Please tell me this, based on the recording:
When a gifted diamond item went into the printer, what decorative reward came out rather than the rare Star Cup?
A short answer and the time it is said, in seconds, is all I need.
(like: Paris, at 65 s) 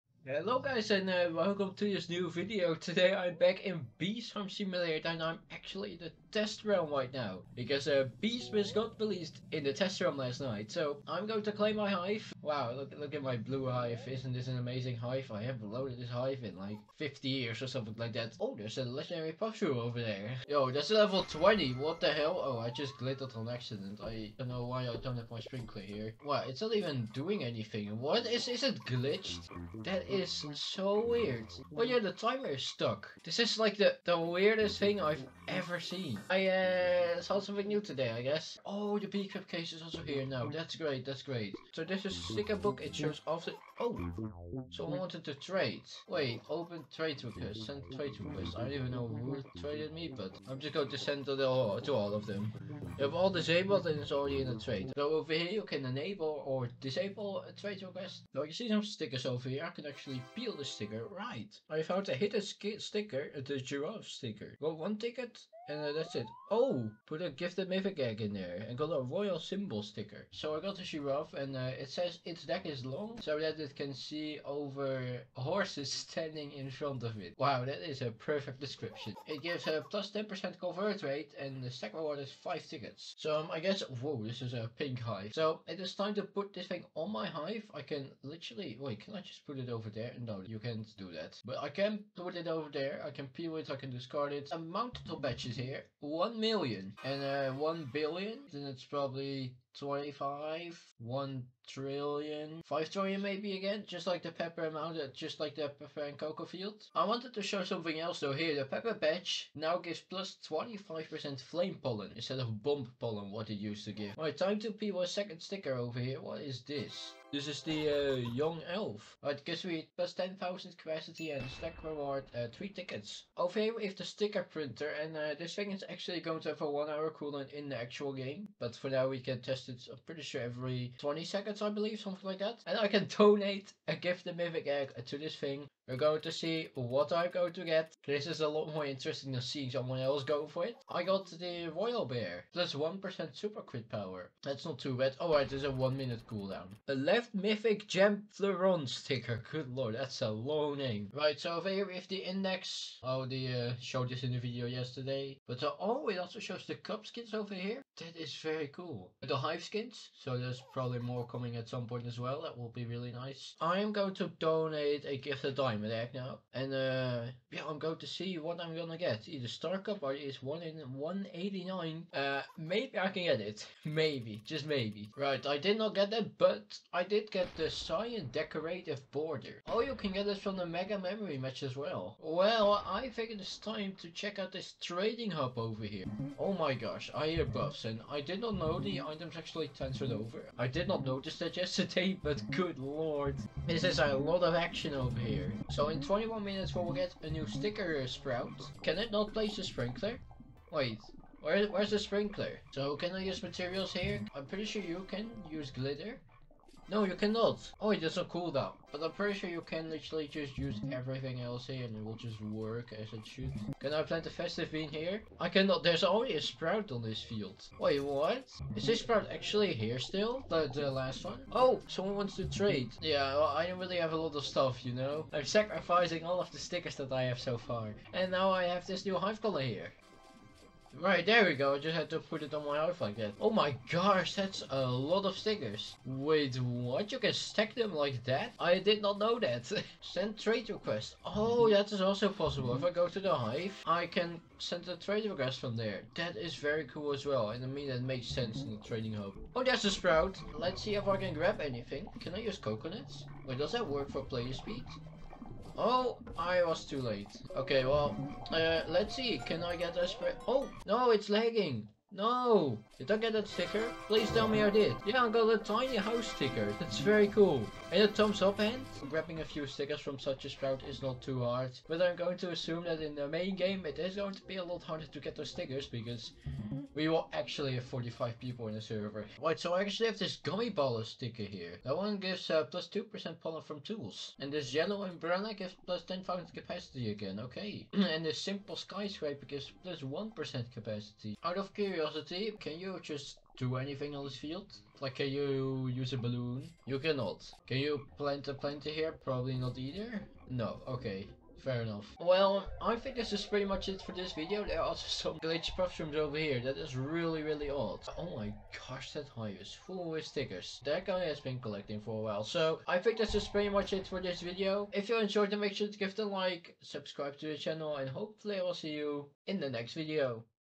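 Cyan Decorative Border, at 177 s.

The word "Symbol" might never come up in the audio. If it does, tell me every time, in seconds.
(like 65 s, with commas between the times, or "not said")
69 s.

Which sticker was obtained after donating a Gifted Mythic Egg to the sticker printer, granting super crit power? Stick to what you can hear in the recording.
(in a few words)
Royal Bear.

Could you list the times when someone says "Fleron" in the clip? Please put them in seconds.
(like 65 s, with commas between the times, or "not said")
148 s.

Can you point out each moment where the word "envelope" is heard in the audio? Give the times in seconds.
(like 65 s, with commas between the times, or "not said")
not said.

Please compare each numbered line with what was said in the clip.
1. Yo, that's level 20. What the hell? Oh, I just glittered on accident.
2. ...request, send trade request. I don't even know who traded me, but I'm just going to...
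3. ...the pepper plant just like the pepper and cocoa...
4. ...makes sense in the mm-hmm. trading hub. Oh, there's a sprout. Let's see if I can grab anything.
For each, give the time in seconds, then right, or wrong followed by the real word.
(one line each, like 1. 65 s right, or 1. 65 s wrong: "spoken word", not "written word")
1. 20 s right
2. 47 s right
3. 104 s wrong: "amount", not "plant"
4. 248 s right.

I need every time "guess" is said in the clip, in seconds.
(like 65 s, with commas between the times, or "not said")
38 s, 83 s.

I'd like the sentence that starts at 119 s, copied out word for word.
Right, gives me plus 10,000 capacity and stack reward uh, 3 tickets.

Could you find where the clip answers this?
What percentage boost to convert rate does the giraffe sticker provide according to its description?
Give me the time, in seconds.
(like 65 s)
79 s.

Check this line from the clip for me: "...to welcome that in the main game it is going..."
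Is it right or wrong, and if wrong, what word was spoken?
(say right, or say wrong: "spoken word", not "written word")
wrong: "assume", not "welcome".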